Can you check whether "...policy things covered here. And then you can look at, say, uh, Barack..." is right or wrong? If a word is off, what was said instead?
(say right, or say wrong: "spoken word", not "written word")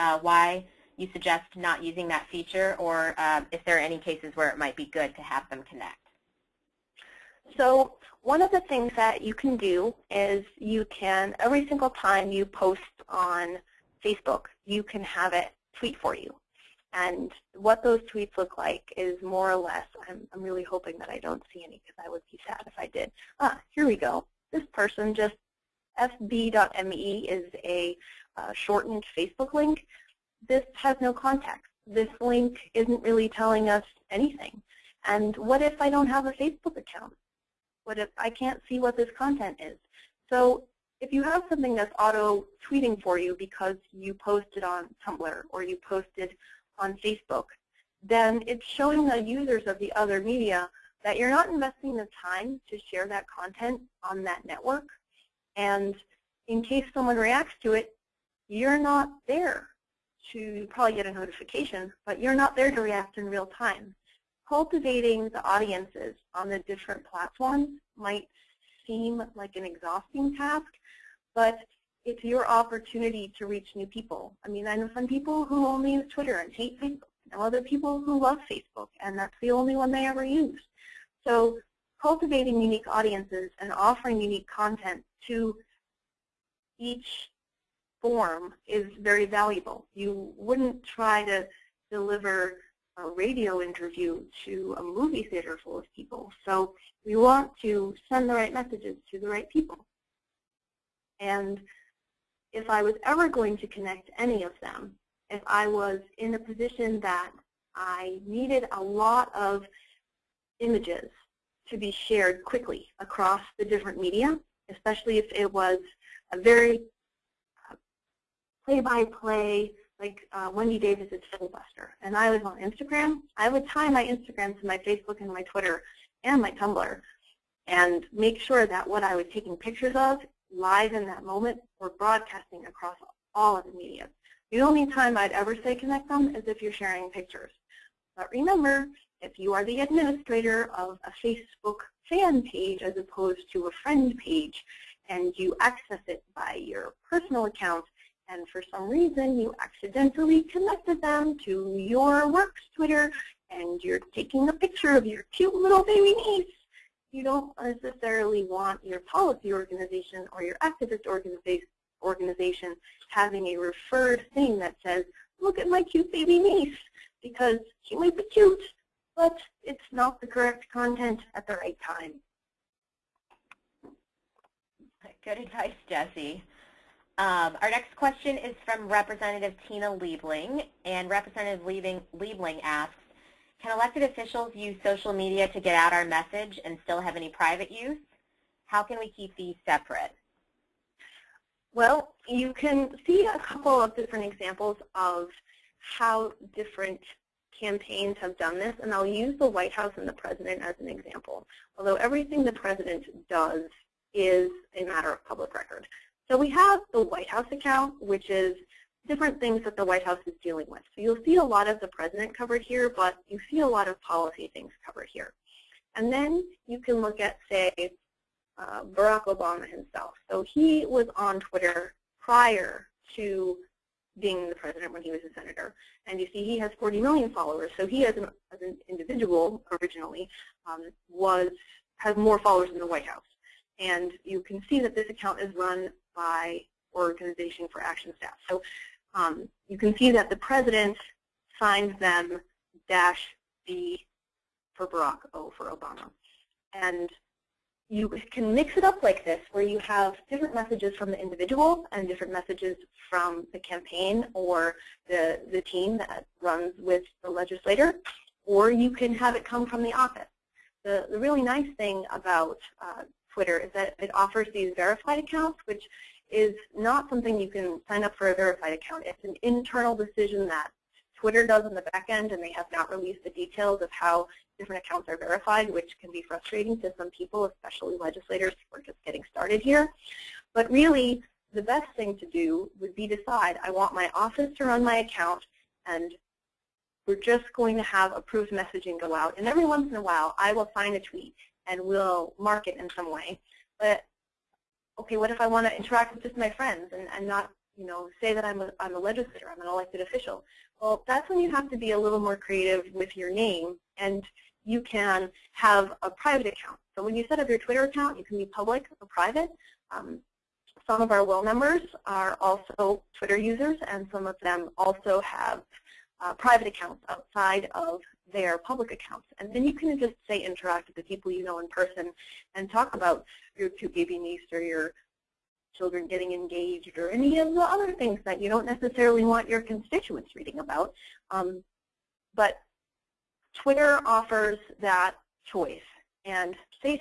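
right.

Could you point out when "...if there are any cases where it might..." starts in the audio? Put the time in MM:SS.
00:03.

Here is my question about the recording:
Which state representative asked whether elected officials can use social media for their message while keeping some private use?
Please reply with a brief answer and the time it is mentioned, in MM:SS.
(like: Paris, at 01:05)
Tina Liebling, at 02:59.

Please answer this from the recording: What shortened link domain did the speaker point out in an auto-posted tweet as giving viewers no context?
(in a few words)
fb.me.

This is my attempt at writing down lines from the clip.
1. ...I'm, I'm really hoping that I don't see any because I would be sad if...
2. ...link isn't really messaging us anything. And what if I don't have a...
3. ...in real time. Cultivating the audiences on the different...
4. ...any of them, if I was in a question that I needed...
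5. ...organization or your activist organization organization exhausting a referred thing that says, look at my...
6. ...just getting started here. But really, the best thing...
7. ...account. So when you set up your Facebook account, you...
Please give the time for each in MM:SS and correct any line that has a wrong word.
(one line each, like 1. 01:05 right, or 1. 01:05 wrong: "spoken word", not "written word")
1. 00:20 right
2. 00:32 wrong: "telling", not "messaging"
3. 01:03 right
4. 01:44 wrong: "position", not "question"
5. 02:39 wrong: "having", not "exhausting"
6. 04:38 right
7. 05:06 wrong: "Twitter", not "Facebook".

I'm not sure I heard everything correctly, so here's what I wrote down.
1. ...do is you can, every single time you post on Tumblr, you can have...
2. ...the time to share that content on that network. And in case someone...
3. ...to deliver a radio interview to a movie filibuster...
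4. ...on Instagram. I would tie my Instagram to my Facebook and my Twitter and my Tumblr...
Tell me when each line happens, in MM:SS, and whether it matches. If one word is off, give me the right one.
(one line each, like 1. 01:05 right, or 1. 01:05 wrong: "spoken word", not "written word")
1. 00:09 wrong: "Facebook", not "Tumblr"
2. 00:51 right
3. 01:31 wrong: "theater", not "filibuster"
4. 02:02 right.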